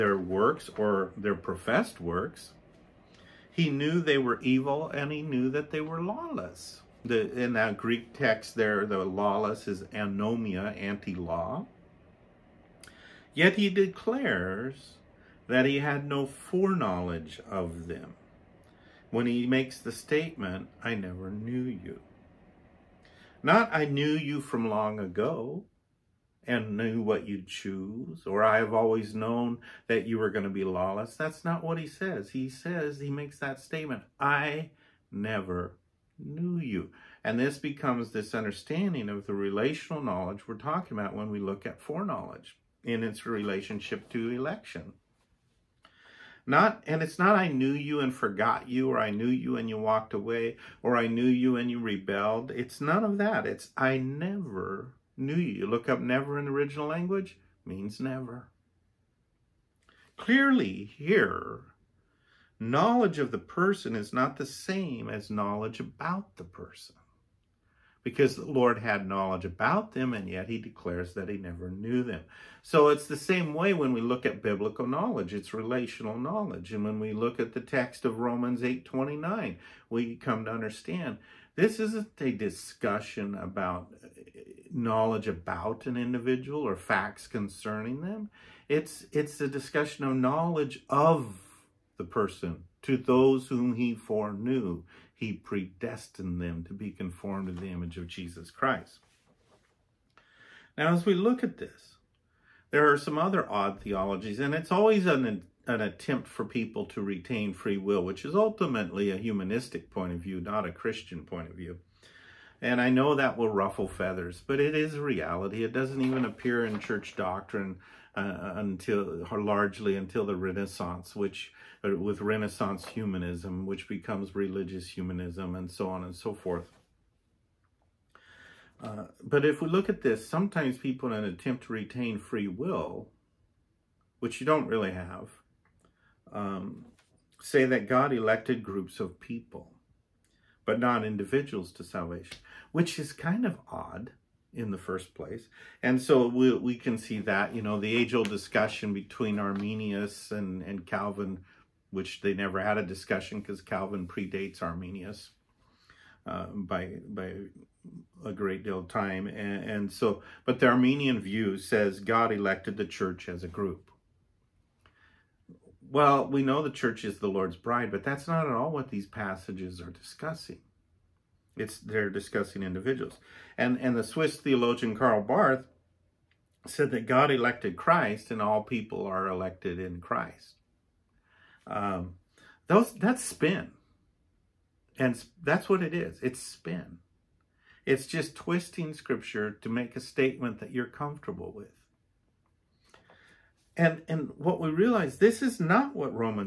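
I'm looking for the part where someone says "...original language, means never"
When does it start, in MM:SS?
00:56.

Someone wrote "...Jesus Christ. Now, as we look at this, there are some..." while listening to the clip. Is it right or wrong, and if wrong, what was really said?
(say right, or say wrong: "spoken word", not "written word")
right.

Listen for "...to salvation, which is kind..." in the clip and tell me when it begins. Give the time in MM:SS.
02:21.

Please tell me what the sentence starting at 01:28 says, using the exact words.
It's, it's a discussion of knowledge of the person.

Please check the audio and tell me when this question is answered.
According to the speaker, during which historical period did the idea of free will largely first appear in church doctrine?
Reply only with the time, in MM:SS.
02:00.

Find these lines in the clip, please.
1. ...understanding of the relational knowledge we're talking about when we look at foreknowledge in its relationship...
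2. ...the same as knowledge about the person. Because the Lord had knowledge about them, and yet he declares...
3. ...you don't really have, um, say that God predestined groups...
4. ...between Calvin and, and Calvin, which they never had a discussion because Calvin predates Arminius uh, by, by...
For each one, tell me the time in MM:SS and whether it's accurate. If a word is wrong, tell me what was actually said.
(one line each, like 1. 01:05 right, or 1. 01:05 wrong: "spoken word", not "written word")
1. 00:38 right
2. 01:04 right
3. 02:14 wrong: "elected", not "predestined"
4. 02:28 wrong: "Arminius", not "Calvin".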